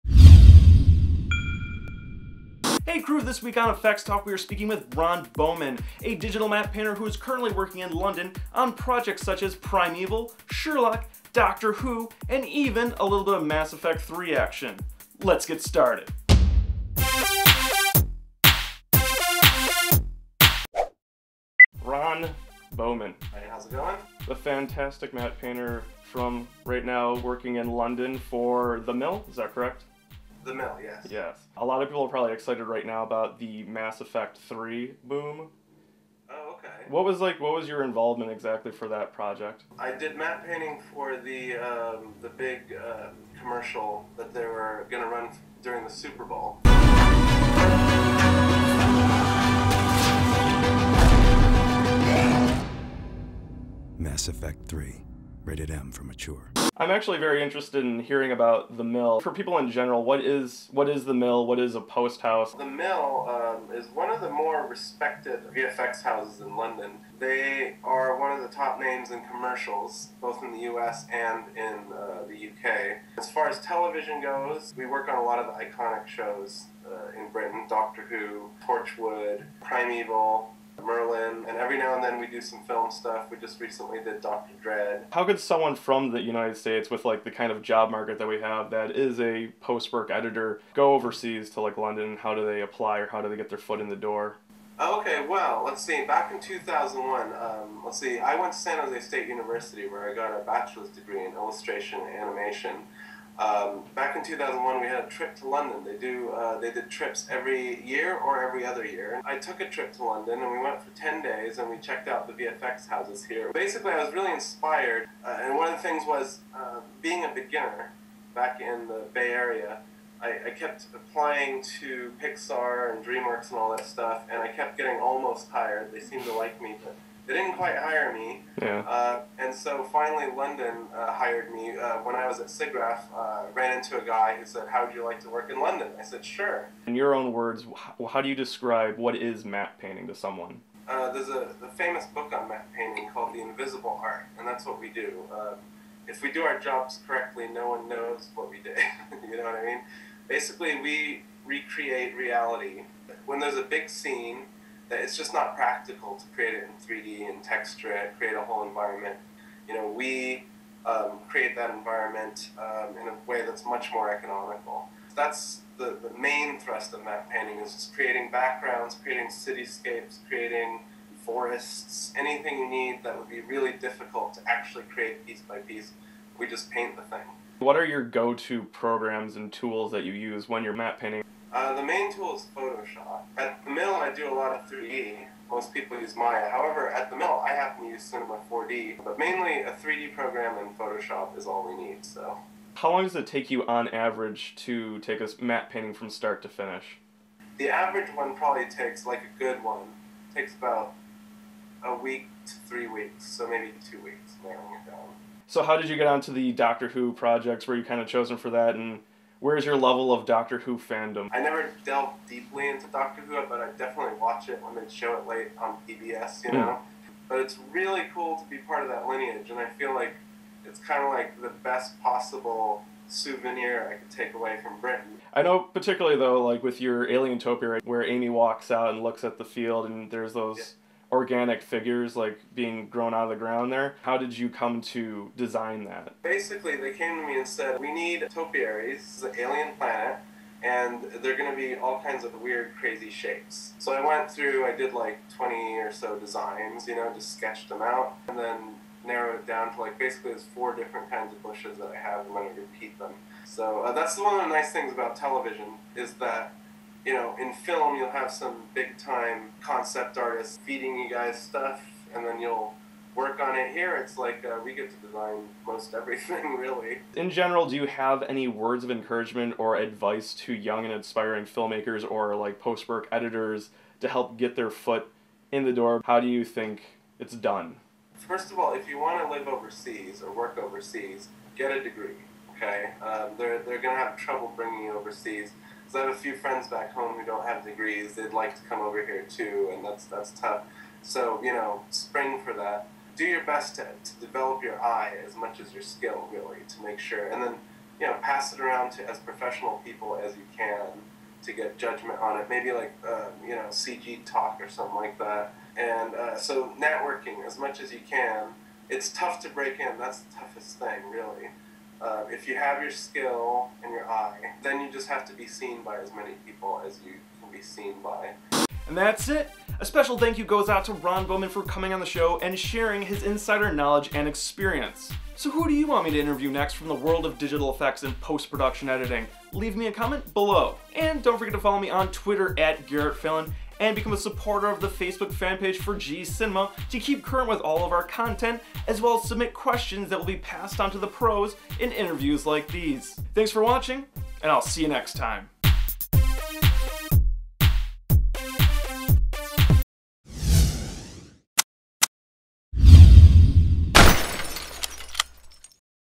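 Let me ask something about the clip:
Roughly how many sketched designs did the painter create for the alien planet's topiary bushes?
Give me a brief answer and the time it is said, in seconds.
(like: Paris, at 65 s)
20, at 245 s.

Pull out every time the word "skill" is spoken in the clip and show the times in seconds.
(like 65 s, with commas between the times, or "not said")
295 s, 312 s.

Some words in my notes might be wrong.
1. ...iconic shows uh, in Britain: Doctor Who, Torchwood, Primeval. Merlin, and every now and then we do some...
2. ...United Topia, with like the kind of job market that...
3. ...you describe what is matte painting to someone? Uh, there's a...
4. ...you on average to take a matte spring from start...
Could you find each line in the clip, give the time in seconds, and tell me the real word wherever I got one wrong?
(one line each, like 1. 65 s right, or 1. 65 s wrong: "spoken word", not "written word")
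1. 75 s right
2. 86 s wrong: "States", not "Topia"
3. 138 s right
4. 193 s wrong: "painting", not "spring".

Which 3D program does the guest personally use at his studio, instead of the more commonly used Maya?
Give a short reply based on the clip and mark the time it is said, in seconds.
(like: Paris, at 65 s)
Cinema 4D, at 188 s.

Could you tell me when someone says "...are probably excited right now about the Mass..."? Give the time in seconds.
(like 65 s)
32 s.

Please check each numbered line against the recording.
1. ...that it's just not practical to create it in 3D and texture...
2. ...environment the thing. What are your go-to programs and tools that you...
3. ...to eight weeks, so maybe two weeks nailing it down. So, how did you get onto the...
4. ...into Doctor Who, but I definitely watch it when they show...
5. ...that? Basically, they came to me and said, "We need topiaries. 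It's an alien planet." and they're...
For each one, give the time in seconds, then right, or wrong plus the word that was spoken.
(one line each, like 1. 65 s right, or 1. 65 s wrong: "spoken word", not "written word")
1. 154 s right
2. 176 s wrong: "paint", not "environment"
3. 202 s wrong: "three", not "eight"
4. 212 s right
5. 235 s right.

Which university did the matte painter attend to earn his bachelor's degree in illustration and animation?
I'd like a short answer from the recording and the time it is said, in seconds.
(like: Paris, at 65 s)
San Jose State University, at 98 s.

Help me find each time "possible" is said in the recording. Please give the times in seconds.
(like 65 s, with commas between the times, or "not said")
222 s.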